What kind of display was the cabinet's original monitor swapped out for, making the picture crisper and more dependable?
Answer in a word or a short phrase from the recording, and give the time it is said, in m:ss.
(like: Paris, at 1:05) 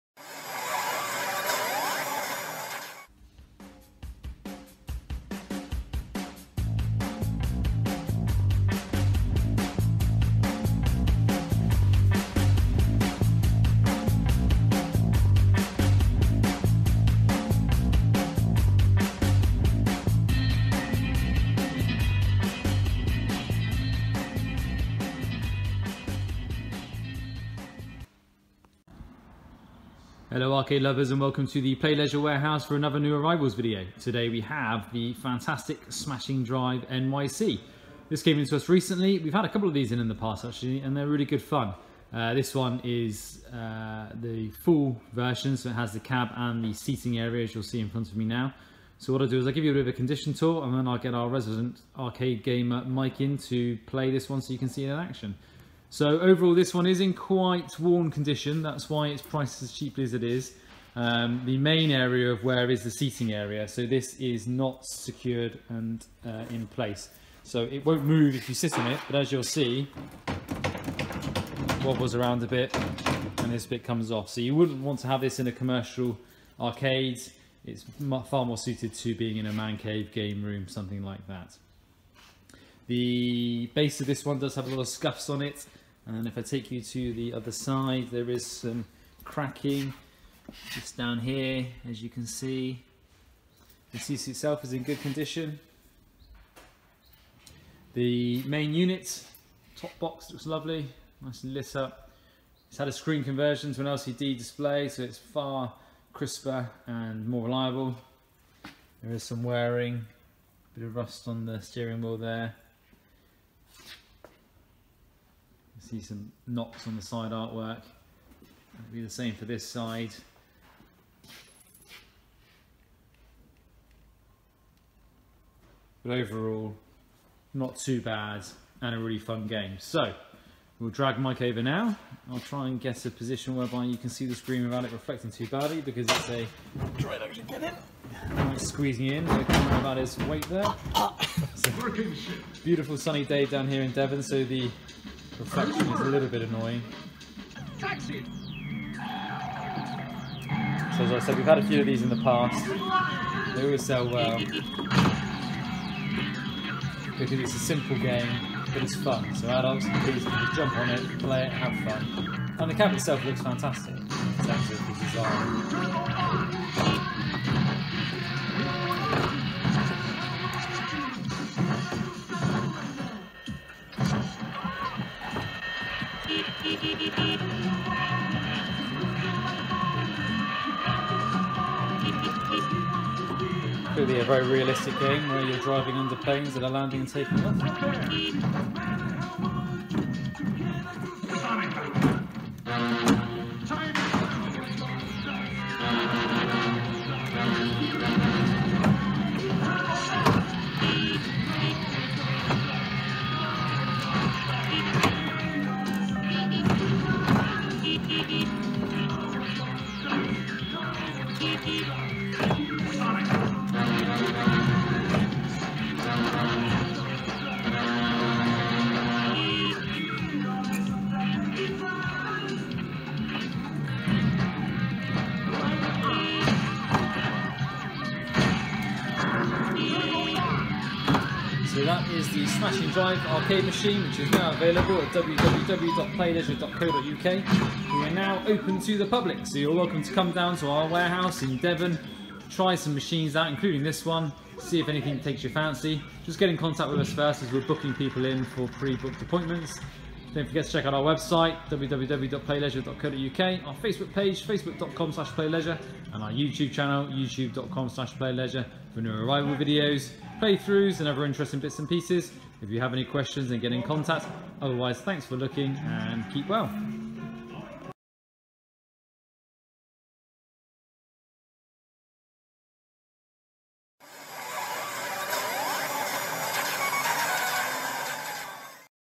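LCD display, at 1:43.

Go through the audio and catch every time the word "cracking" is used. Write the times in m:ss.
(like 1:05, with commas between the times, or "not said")
1:29.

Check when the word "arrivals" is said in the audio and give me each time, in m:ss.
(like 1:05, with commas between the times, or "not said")
0:33, 4:19.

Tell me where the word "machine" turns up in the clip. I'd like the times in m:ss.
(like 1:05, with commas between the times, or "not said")
3:53, 4:02.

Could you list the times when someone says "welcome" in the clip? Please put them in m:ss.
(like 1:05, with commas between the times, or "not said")
0:31, 3:59.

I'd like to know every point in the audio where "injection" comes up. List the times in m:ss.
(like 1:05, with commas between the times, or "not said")
not said.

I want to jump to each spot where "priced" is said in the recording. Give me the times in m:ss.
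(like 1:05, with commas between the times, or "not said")
0:59.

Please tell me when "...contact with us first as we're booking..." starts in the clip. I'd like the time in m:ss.
4:06.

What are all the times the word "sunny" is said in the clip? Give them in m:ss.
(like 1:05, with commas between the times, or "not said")
2:22.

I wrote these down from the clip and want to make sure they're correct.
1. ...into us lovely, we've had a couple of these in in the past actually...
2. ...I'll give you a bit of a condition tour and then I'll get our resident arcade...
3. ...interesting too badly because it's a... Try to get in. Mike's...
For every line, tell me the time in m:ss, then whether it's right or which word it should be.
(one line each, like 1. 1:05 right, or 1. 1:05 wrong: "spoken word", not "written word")
1. 0:38 wrong: "recently", not "lovely"
2. 0:49 right
3. 2:14 wrong: "reflecting", not "interesting".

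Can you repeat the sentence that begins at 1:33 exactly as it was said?
The CC itself is in good condition.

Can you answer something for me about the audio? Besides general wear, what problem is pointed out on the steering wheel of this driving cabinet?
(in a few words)
rust.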